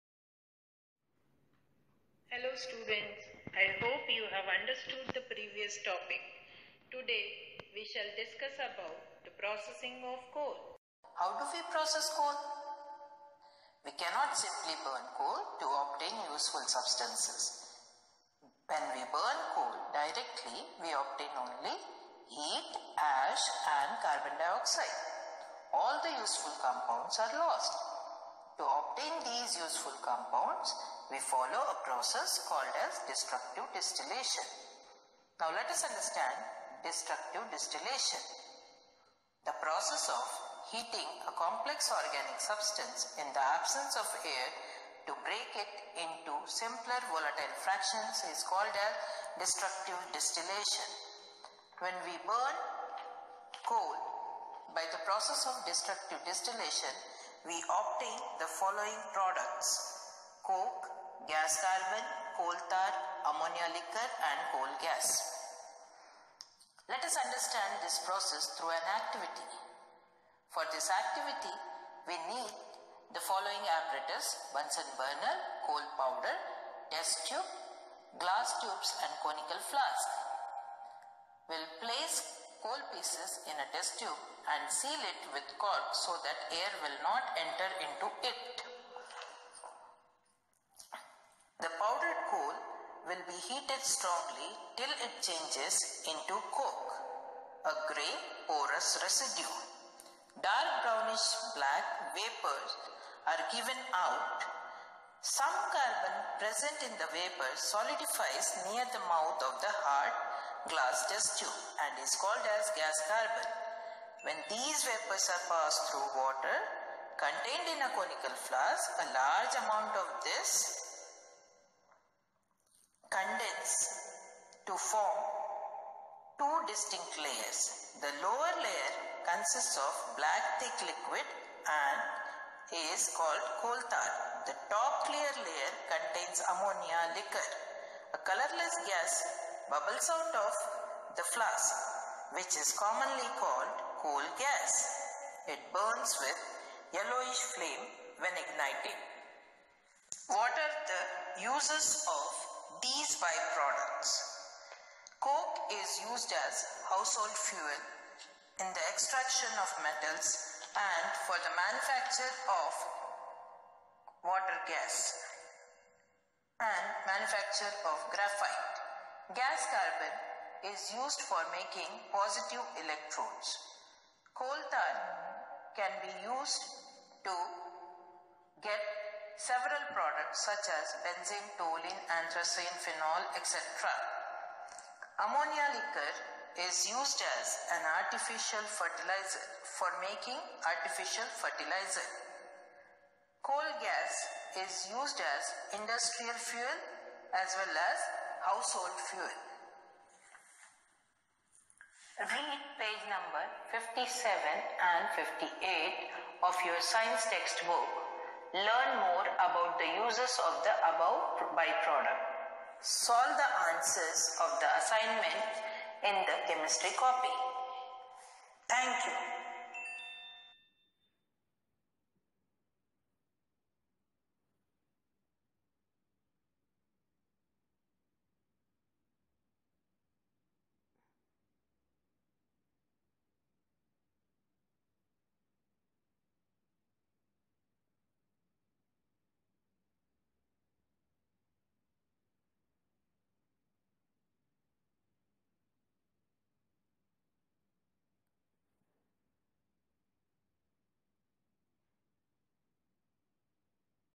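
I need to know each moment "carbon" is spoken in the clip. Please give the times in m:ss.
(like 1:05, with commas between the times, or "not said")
0:23, 1:01, 1:45, 1:53, 2:49.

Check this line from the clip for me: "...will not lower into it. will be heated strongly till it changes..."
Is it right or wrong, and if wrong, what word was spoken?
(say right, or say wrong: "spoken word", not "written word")
wrong: "enter", not "lower".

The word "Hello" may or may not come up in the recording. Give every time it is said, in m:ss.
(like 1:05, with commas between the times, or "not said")
0:02.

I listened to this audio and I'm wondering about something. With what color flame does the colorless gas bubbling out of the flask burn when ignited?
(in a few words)
Yellowish.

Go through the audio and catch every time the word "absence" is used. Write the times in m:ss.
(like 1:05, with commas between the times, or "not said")
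0:43.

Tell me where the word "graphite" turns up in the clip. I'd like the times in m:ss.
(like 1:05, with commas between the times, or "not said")
2:48.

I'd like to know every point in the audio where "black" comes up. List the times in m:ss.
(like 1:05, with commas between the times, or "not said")
1:41, 2:10.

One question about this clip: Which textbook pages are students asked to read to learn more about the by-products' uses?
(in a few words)
57 and 58.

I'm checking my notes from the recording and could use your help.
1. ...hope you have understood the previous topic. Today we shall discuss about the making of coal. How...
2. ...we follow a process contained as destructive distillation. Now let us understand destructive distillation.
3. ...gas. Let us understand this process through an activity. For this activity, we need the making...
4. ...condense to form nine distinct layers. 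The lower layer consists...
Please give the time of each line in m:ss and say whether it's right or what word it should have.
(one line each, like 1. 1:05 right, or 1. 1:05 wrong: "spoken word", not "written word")
1. 0:03 wrong: "processing", not "making"
2. 0:31 wrong: "called", not "contained"
3. 1:04 wrong: "following", not "making"
4. 2:03 wrong: "two", not "nine".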